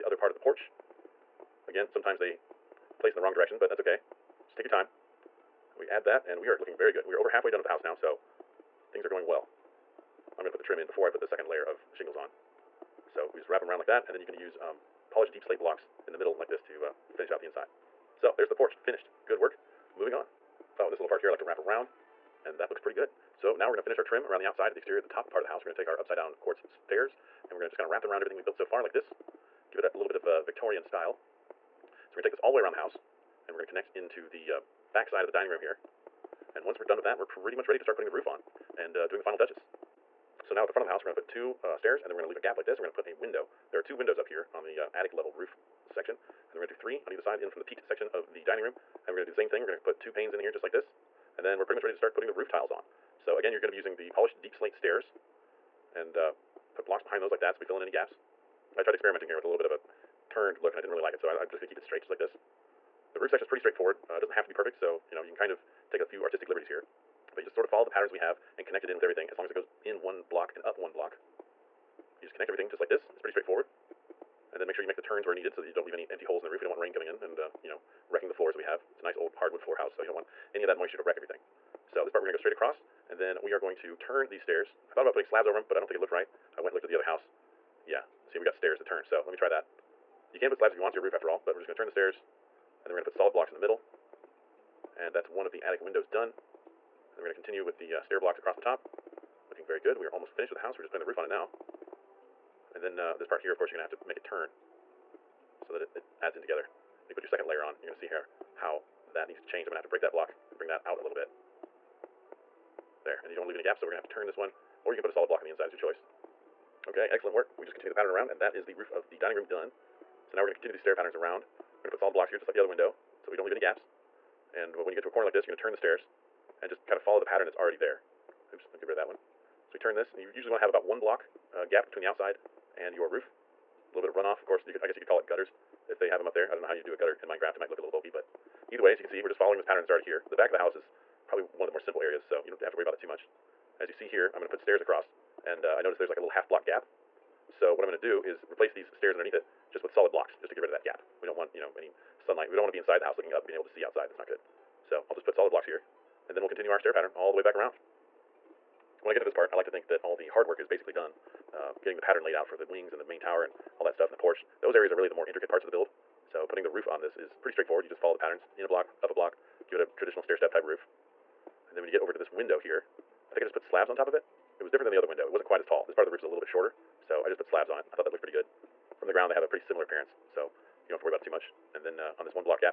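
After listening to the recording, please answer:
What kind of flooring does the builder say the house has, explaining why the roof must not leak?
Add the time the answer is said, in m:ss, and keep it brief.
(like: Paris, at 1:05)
hardwood, at 1:19.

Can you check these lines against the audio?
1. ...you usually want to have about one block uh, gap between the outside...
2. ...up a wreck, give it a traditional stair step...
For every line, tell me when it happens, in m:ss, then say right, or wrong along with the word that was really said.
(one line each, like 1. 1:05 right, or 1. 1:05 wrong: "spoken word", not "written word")
1. 2:10 right
2. 2:49 wrong: "block", not "wreck".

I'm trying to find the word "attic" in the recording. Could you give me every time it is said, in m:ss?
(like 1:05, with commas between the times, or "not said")
0:44, 1:35.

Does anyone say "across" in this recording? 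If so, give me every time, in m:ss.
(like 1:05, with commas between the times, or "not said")
1:22, 1:38, 2:24.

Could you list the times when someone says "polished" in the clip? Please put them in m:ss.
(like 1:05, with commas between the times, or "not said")
0:15, 0:54.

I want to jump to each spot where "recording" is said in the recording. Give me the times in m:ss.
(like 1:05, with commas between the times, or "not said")
not said.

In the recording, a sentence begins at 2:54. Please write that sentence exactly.
It was different than the other window.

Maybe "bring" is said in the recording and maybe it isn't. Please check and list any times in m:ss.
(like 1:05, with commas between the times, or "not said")
1:50.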